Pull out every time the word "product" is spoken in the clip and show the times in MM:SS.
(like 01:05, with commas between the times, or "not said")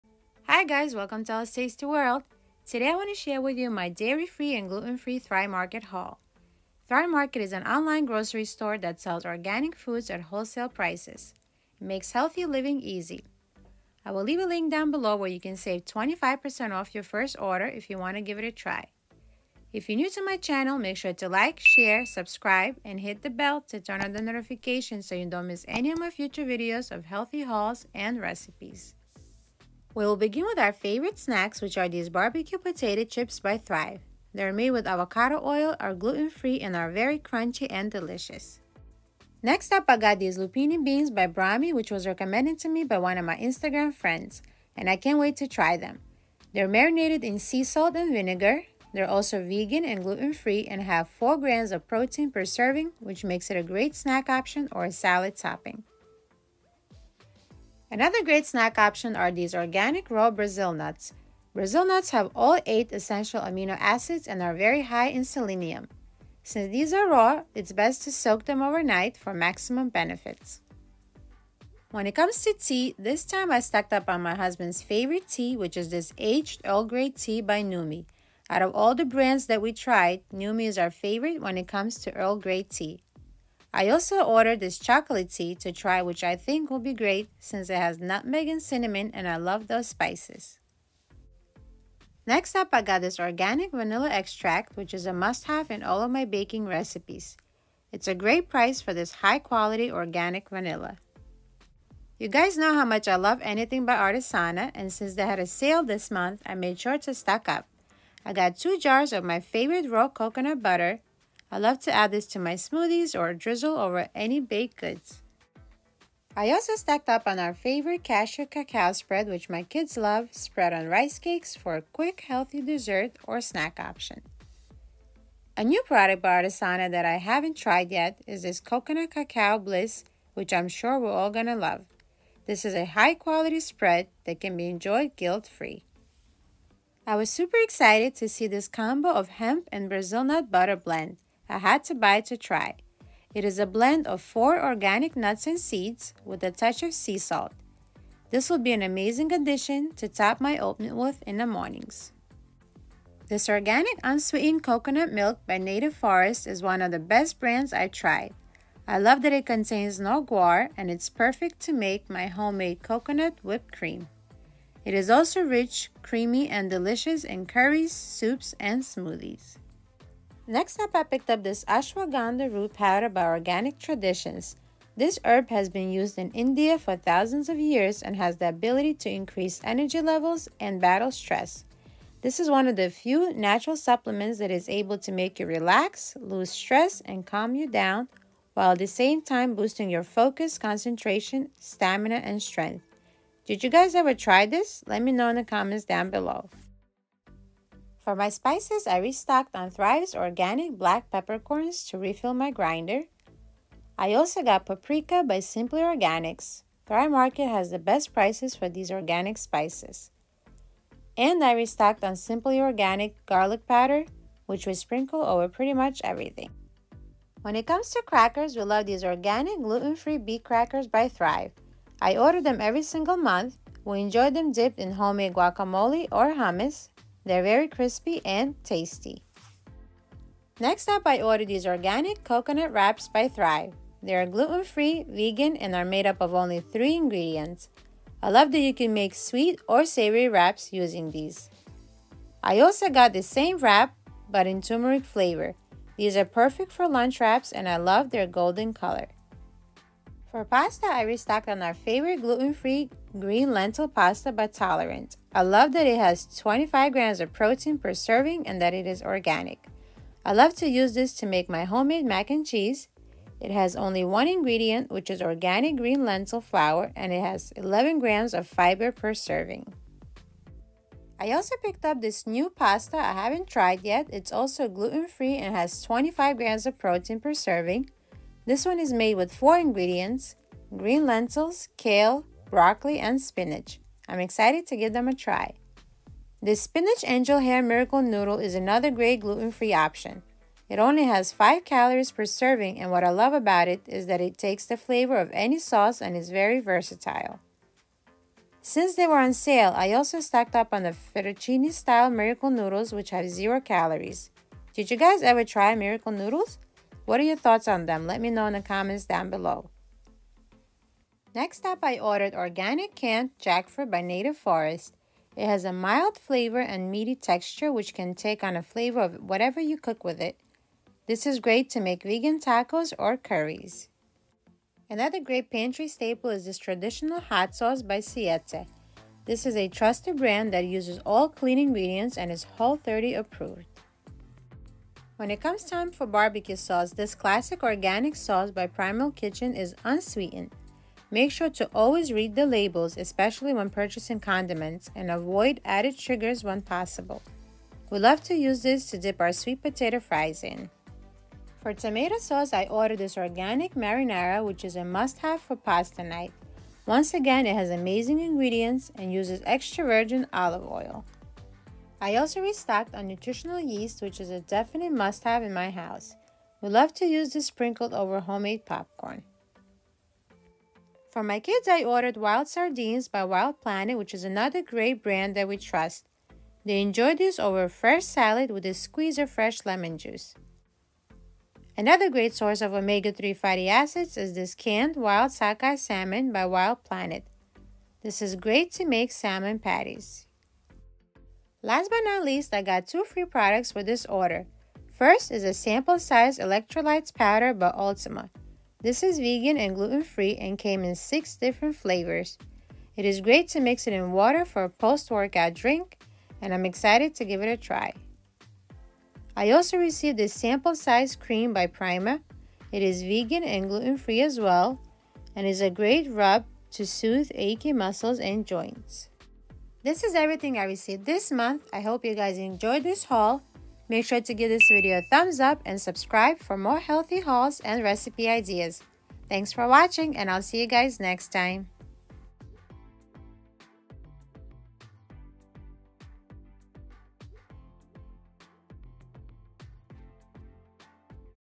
02:05, 06:33.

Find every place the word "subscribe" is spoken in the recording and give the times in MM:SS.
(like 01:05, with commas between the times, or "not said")
00:22, 07:05.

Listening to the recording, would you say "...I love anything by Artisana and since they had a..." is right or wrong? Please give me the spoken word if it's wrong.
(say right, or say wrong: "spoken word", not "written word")
right.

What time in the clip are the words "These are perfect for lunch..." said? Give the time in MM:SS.
04:05.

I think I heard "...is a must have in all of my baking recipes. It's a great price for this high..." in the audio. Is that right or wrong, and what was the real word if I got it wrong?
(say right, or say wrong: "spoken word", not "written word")
right.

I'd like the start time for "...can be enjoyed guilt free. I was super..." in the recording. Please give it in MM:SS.
02:14.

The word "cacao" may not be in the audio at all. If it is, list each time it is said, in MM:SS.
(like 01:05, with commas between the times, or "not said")
01:58, 02:09.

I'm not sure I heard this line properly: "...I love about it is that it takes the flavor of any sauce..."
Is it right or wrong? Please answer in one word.
right.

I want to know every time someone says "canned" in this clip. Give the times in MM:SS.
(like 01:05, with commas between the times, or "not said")
05:12, 06:24.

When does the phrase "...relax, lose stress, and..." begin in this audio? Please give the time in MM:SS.
03:05.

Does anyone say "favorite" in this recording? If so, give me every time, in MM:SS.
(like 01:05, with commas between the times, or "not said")
00:30, 01:14, 01:20, 01:49, 01:57, 04:11.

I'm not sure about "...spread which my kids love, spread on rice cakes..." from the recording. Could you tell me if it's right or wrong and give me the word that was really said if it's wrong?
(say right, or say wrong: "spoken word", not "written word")
right.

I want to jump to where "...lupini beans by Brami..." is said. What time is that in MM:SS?
00:40.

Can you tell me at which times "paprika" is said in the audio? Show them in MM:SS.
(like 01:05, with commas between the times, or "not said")
03:24.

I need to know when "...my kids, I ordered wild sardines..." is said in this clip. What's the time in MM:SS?
06:11.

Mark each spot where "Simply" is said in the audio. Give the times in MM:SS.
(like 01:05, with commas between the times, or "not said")
03:25, 03:32.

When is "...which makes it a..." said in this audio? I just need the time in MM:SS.
00:53.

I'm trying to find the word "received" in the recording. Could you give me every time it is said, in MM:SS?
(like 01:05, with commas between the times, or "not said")
06:49, 07:00.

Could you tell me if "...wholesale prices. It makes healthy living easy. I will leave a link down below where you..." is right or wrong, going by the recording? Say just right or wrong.
right.